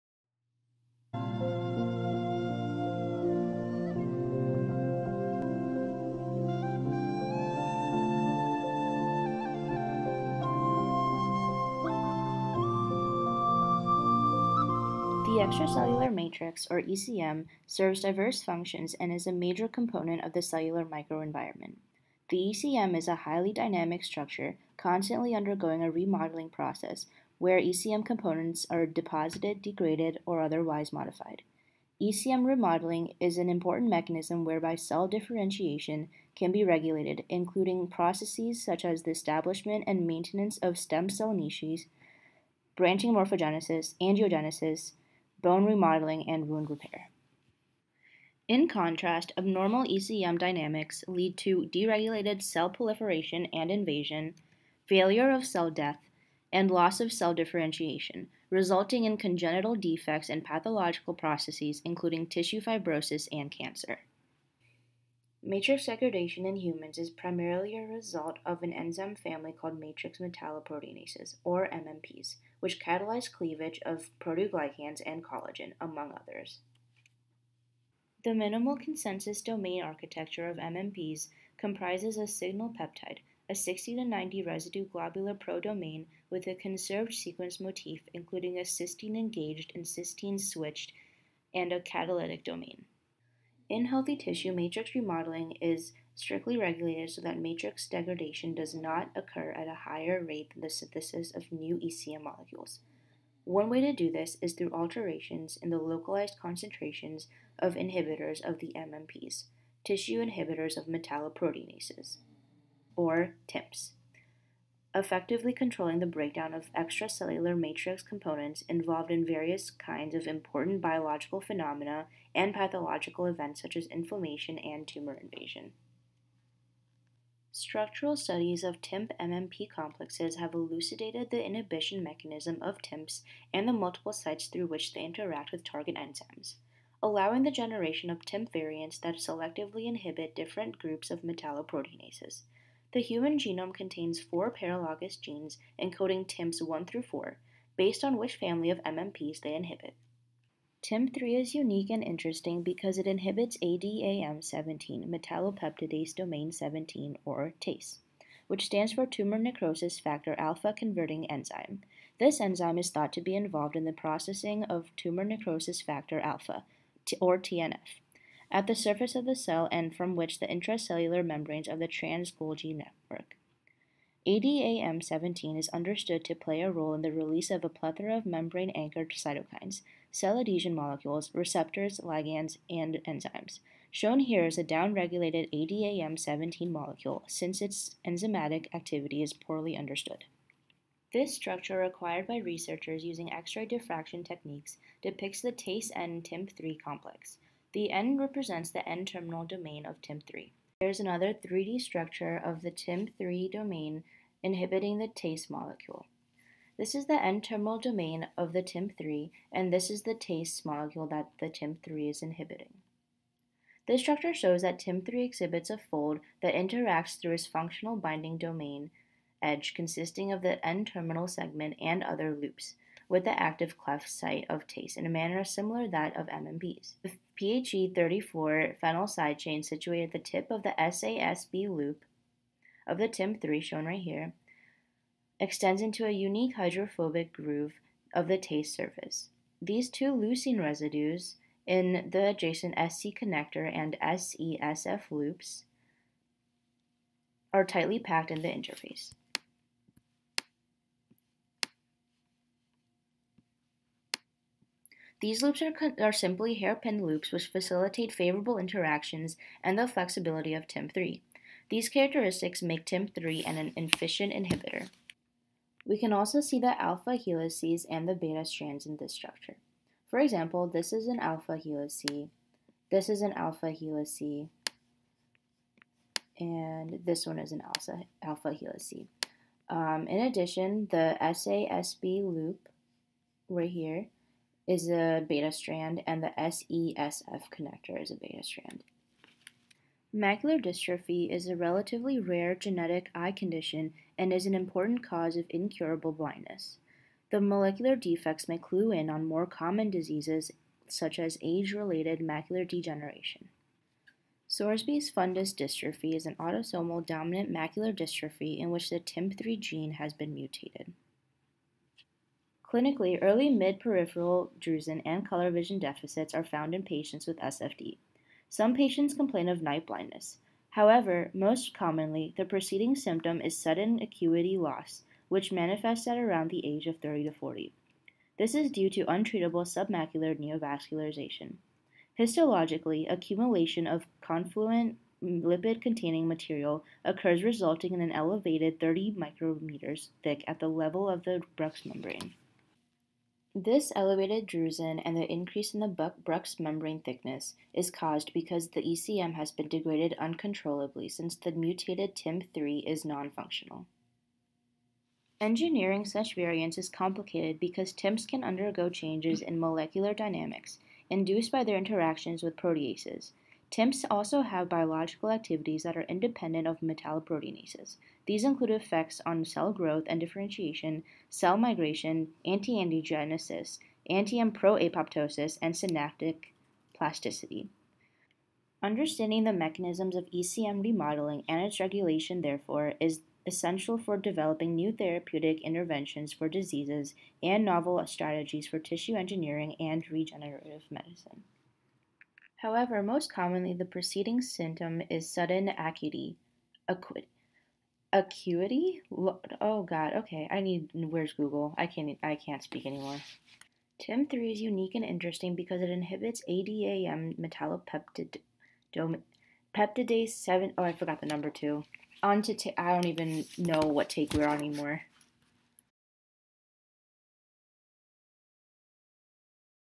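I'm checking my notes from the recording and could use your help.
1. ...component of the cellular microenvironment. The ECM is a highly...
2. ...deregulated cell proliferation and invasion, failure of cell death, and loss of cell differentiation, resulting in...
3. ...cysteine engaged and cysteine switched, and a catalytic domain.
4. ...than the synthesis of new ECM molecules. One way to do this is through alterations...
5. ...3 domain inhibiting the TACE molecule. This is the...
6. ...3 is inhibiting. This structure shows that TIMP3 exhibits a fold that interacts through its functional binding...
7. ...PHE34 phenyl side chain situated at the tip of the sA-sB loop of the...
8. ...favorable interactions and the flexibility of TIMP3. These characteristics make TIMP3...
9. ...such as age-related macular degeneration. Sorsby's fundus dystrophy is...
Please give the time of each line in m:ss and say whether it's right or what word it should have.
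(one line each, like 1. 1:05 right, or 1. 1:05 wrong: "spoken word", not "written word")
1. 0:19 right
2. 0:51 right
3. 1:28 right
4. 1:40 right
5. 3:23 right
6. 3:31 right
7. 3:47 right
8. 4:18 right
9. 5:00 right.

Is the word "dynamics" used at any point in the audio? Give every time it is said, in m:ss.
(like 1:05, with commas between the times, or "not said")
0:23, 0:50, 6:00.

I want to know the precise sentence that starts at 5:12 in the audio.
Clinically, early mid-peripheral drusen and color vision deficits are found in patients with SFD.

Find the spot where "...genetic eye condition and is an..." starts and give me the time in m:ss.
4:52.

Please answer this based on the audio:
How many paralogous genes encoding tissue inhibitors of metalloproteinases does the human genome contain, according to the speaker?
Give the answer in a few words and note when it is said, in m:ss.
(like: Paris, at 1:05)
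4, at 2:24.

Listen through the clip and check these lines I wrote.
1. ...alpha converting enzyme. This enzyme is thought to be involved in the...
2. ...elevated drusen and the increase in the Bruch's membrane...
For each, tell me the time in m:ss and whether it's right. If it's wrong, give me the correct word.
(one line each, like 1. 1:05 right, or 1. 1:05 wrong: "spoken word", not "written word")
1. 2:40 right
2. 5:43 right.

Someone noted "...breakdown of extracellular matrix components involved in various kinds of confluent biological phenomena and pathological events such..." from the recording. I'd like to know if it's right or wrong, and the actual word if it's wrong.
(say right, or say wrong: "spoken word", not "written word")
wrong: "important", not "confluent".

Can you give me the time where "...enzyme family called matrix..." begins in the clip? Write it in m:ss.
1:08.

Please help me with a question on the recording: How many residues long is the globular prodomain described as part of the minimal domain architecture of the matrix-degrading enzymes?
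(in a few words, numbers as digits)
60 to 90.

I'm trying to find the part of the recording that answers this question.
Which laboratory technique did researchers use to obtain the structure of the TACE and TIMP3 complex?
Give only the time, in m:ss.
3:13.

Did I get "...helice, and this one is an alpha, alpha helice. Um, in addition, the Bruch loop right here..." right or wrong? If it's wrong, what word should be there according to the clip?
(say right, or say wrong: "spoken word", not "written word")
wrong: "SASB", not "Bruch".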